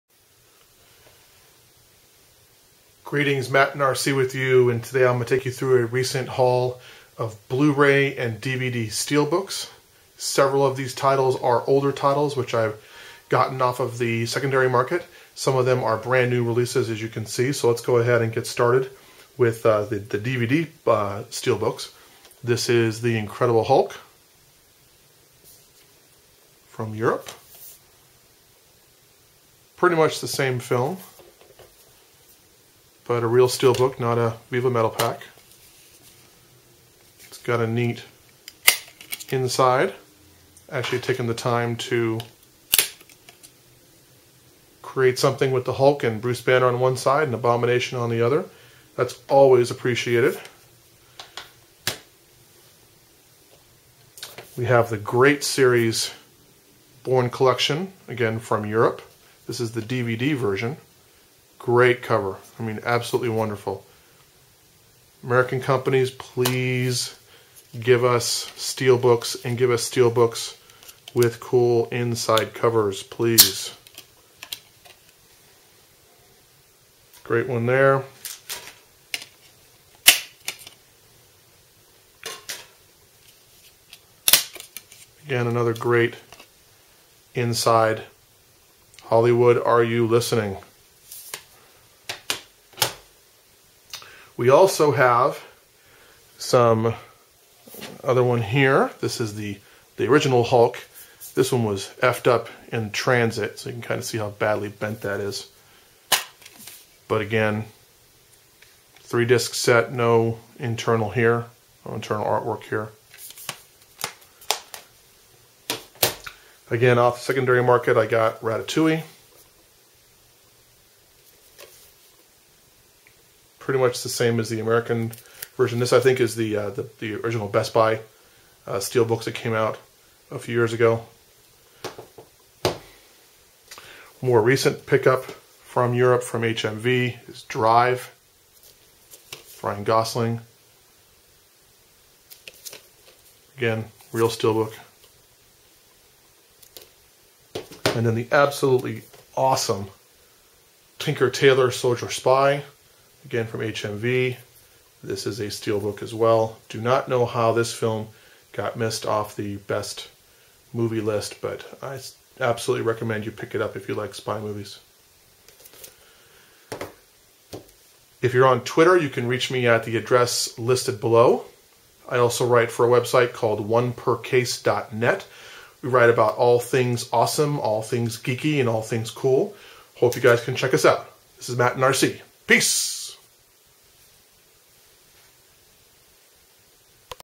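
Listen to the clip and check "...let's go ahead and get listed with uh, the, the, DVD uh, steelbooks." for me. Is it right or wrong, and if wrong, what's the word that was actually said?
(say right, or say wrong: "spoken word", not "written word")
wrong: "started", not "listed".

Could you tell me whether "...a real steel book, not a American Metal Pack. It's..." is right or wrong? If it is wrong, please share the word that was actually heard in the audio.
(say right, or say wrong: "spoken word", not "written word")
wrong: "Viva", not "American".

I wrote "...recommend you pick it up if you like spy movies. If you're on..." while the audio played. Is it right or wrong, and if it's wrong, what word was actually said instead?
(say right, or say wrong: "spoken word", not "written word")
right.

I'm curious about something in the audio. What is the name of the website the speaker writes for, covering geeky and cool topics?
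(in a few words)
onepercase.net.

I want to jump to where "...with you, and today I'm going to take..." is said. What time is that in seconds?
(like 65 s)
4 s.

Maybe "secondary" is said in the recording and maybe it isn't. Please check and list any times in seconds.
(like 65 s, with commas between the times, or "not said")
14 s, 117 s.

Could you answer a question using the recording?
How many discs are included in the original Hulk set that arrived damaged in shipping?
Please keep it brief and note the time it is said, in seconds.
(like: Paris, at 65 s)
3, at 108 s.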